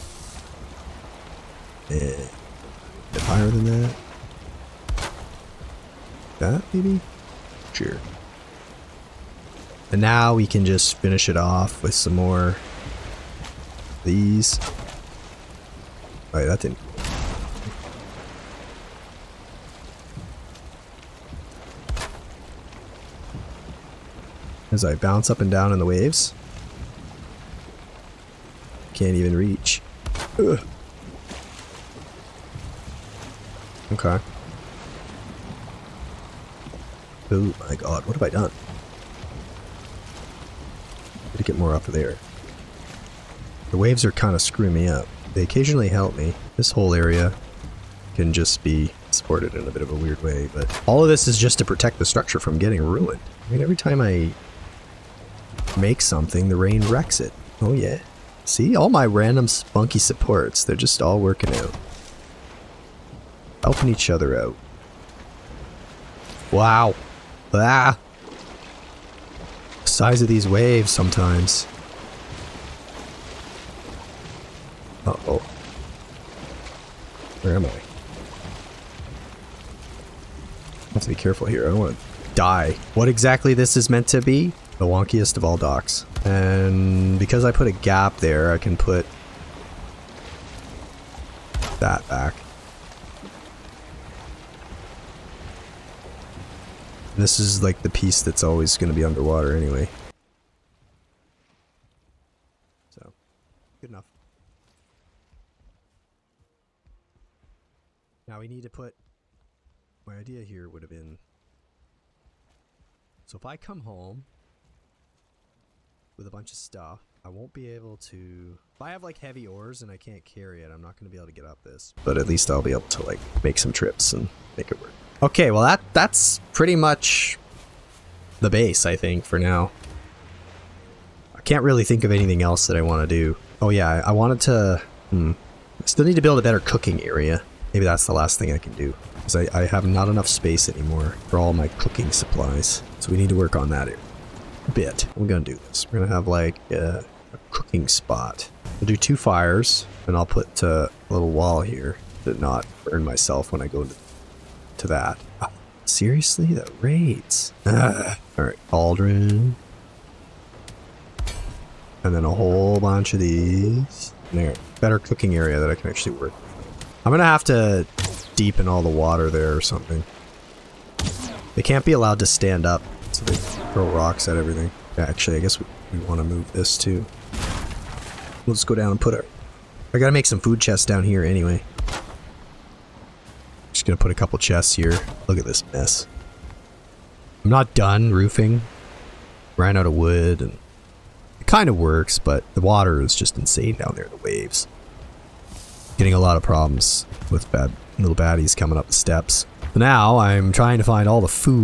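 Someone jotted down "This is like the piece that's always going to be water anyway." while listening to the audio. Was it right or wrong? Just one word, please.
wrong.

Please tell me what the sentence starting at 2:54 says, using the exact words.
Yeah, actually, I guess we, we want to move this too.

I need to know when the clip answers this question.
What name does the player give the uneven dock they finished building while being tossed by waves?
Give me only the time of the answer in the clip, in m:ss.
1:24.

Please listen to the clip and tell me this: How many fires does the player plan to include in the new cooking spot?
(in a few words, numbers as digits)
2.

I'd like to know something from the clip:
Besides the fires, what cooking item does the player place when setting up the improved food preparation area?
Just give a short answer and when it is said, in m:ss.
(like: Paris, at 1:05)
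Cauldron, at 2:38.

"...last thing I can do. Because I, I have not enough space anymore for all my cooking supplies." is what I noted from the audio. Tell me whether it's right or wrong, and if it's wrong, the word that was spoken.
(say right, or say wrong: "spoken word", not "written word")
right.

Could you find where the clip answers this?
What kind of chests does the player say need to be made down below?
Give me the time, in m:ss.
3:00.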